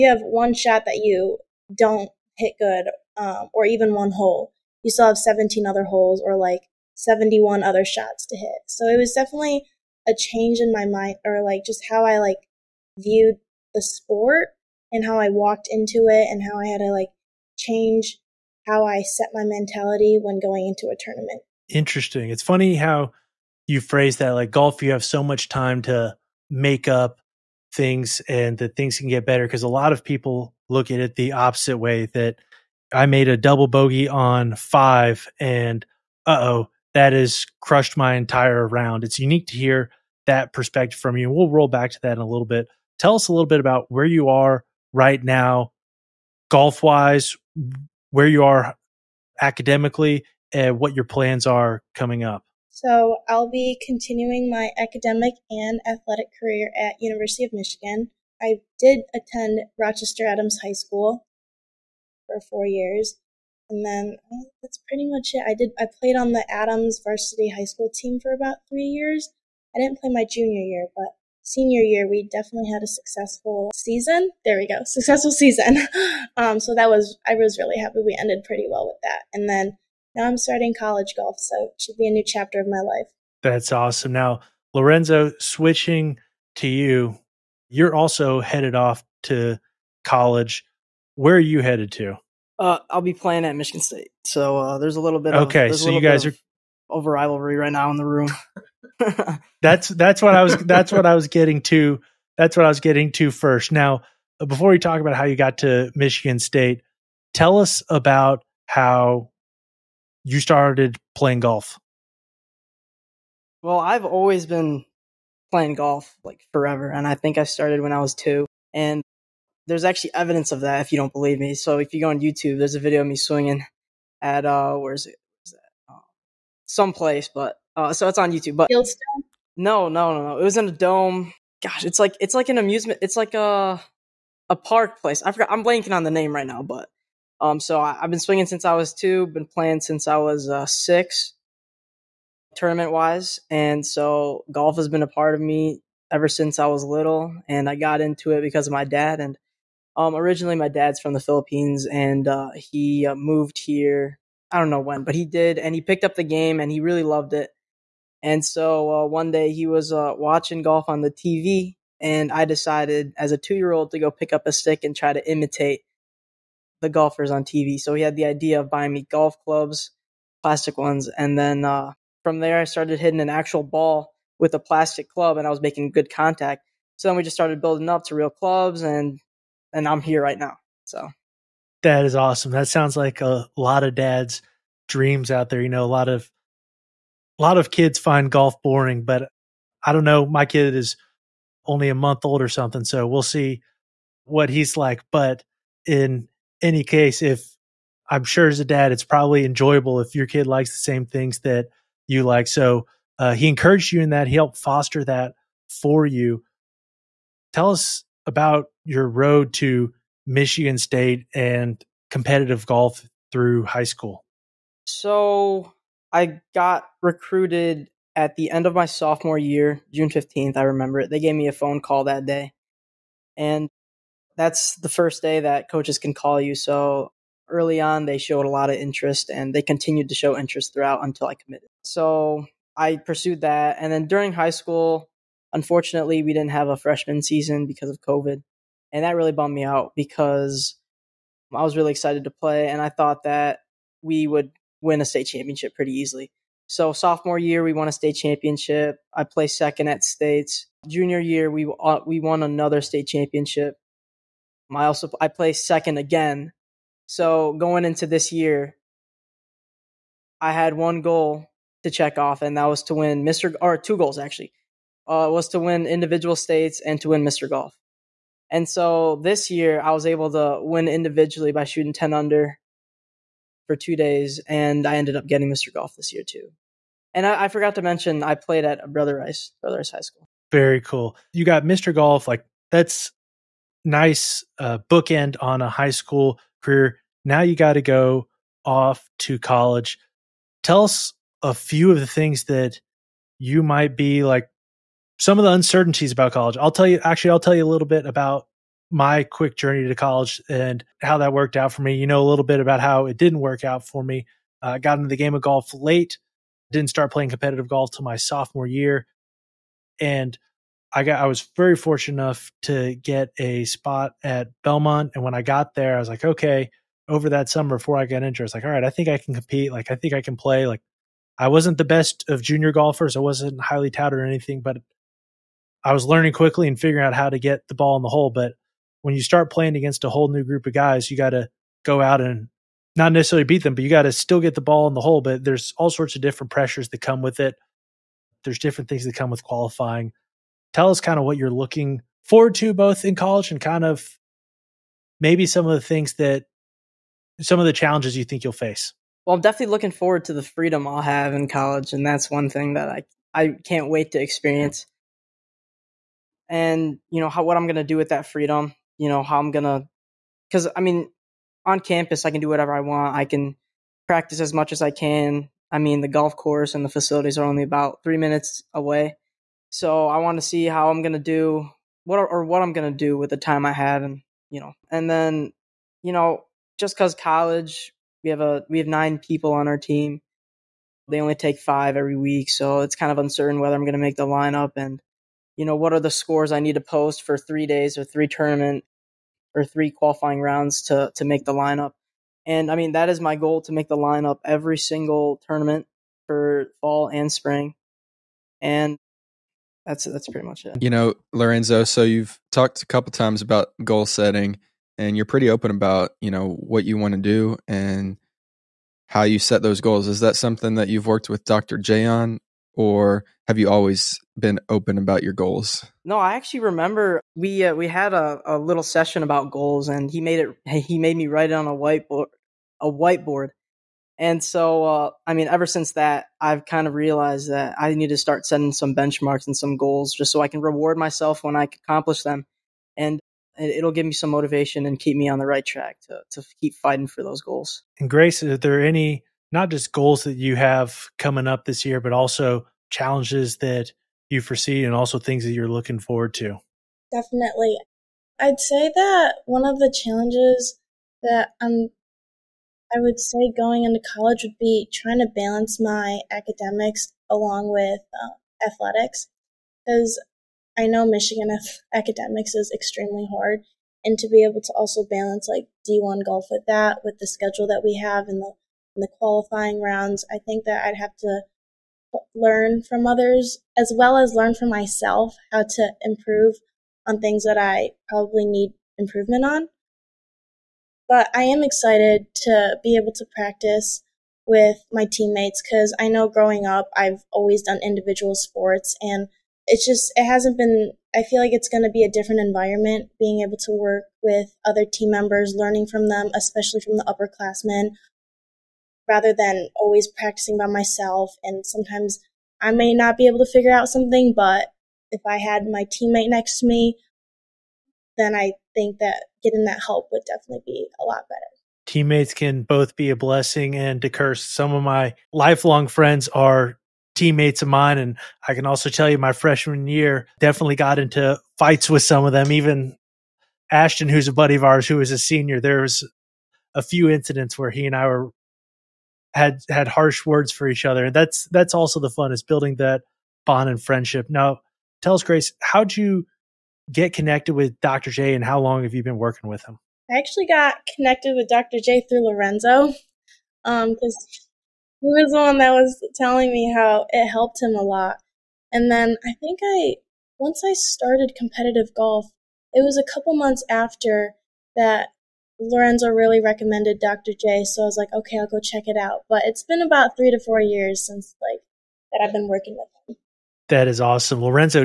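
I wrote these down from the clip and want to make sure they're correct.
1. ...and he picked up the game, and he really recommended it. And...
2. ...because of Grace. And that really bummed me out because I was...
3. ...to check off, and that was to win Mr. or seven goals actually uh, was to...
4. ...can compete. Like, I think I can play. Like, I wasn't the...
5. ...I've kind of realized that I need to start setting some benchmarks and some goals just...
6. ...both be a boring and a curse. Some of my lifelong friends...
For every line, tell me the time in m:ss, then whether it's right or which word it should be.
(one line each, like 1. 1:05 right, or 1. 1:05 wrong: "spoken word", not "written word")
1. 2:35 wrong: "loved", not "recommended"
2. 3:57 wrong: "COVID", not "Grace"
3. 4:21 wrong: "two", not "seven"
4. 5:19 right
5. 7:06 right
6. 8:32 wrong: "blessing", not "boring".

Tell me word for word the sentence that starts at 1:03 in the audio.
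And then um, that's pretty much it.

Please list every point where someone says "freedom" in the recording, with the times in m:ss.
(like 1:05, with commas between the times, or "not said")
5:50, 5:58.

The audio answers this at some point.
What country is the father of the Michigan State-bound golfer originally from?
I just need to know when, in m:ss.
2:31.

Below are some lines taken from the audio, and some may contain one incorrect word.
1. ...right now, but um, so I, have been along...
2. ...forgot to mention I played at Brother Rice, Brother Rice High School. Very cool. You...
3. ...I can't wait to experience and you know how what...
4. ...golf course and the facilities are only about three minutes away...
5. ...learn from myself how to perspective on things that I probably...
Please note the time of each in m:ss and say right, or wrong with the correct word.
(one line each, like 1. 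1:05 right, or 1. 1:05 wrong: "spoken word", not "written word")
1. 2:16 wrong: "swinging", not "along"
2. 4:37 right
3. 5:53 right
4. 6:06 right
5. 7:54 wrong: "improve", not "perspective".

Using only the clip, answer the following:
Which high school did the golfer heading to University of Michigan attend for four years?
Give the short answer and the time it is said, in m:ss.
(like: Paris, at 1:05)
Rochester Adams High School, at 0:59.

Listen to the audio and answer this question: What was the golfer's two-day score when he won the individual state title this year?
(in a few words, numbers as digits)
10 under.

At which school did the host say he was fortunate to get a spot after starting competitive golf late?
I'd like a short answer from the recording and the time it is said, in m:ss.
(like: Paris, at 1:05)
Belmont, at 5:14.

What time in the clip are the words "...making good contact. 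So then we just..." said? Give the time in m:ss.
2:55.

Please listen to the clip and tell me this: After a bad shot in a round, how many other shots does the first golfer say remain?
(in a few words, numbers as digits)
71.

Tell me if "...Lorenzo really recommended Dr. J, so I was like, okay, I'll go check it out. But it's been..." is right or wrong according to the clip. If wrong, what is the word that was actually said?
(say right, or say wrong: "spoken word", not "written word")
right.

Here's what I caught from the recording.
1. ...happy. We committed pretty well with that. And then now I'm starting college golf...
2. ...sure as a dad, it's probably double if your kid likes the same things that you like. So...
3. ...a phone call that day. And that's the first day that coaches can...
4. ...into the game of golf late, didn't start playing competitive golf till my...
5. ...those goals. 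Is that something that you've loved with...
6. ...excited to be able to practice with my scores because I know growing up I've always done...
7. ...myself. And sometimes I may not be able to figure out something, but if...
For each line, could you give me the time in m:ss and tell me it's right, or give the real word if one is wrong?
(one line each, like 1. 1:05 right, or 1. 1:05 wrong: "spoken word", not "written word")
1. 1:17 wrong: "ended", not "committed"
2. 3:18 wrong: "enjoyable", not "double"
3. 3:41 right
4. 5:04 right
5. 6:49 wrong: "worked", not "loved"
6. 8:01 wrong: "teammates", not "scores"
7. 8:20 right.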